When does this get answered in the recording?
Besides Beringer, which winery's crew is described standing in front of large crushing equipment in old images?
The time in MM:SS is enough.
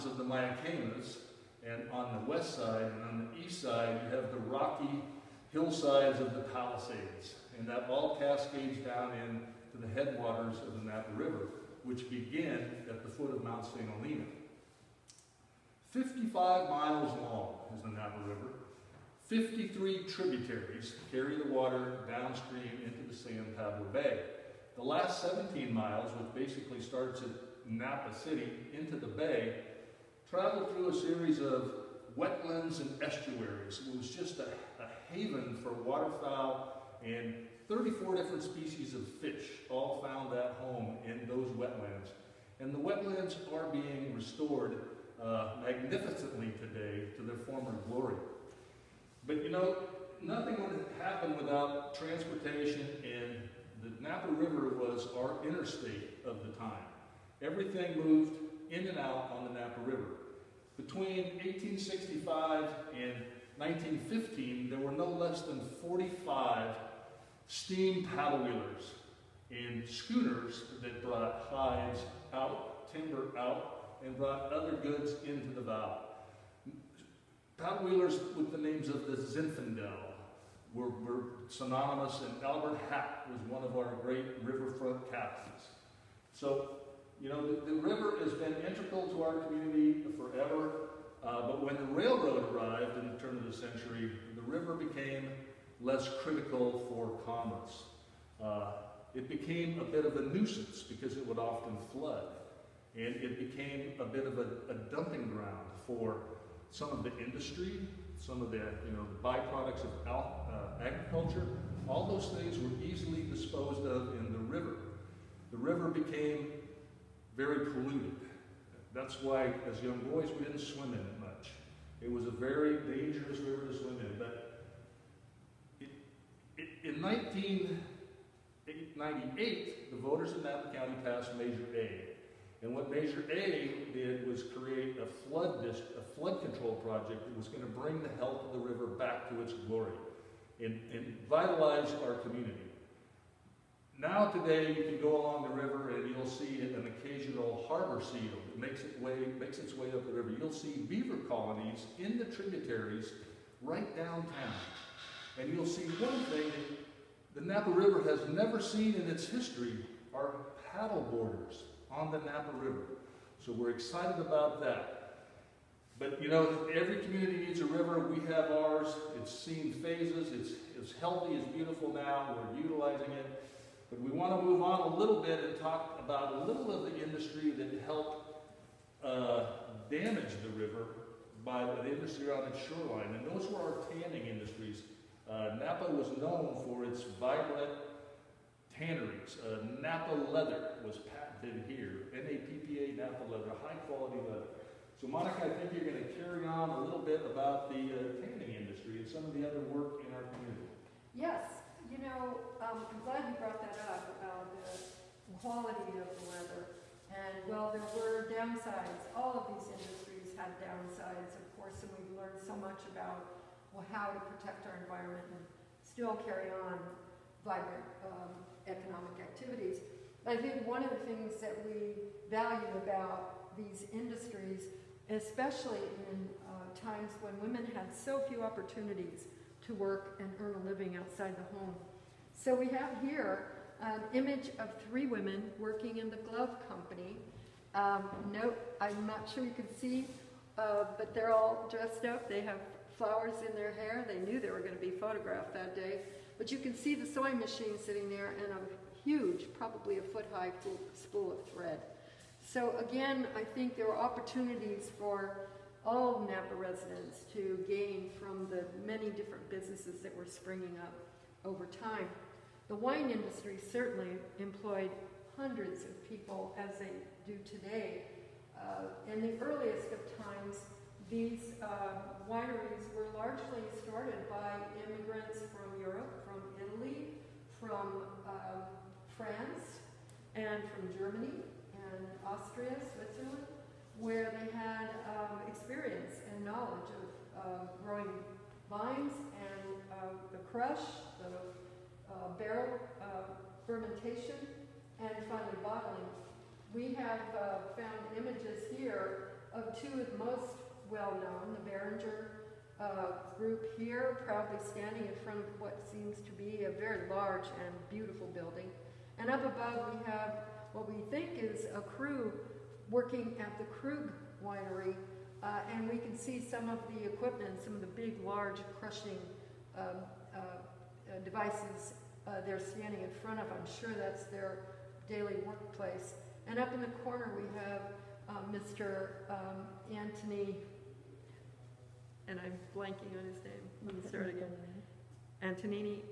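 05:13.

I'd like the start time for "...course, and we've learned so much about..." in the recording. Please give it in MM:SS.
03:31.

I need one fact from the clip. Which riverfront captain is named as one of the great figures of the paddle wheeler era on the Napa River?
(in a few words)
Albert Hatt.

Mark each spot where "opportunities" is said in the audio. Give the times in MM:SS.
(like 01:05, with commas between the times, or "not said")
03:48, 04:13.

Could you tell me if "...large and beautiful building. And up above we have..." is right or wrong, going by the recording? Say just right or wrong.
right.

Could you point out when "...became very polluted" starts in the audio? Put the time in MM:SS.
01:55.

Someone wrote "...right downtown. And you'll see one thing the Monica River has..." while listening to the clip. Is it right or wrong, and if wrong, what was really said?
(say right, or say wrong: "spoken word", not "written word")
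wrong: "Napa", not "Monica".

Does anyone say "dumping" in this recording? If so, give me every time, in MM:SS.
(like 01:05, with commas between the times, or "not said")
01:44.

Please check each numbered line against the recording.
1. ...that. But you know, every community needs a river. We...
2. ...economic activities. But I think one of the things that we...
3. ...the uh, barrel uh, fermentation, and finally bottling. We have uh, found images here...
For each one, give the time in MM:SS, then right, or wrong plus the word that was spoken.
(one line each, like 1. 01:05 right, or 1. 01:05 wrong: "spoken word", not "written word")
1. 02:44 right
2. 03:38 right
3. 04:51 right.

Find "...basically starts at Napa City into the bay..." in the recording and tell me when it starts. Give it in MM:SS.
00:26.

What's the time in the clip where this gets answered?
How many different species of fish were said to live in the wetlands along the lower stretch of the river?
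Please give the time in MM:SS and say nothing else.
00:37.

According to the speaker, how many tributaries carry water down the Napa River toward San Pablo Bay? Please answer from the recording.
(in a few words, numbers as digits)
53.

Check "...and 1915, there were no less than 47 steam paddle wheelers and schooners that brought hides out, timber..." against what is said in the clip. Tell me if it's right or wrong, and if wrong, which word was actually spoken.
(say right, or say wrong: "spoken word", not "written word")
wrong: "45", not "47".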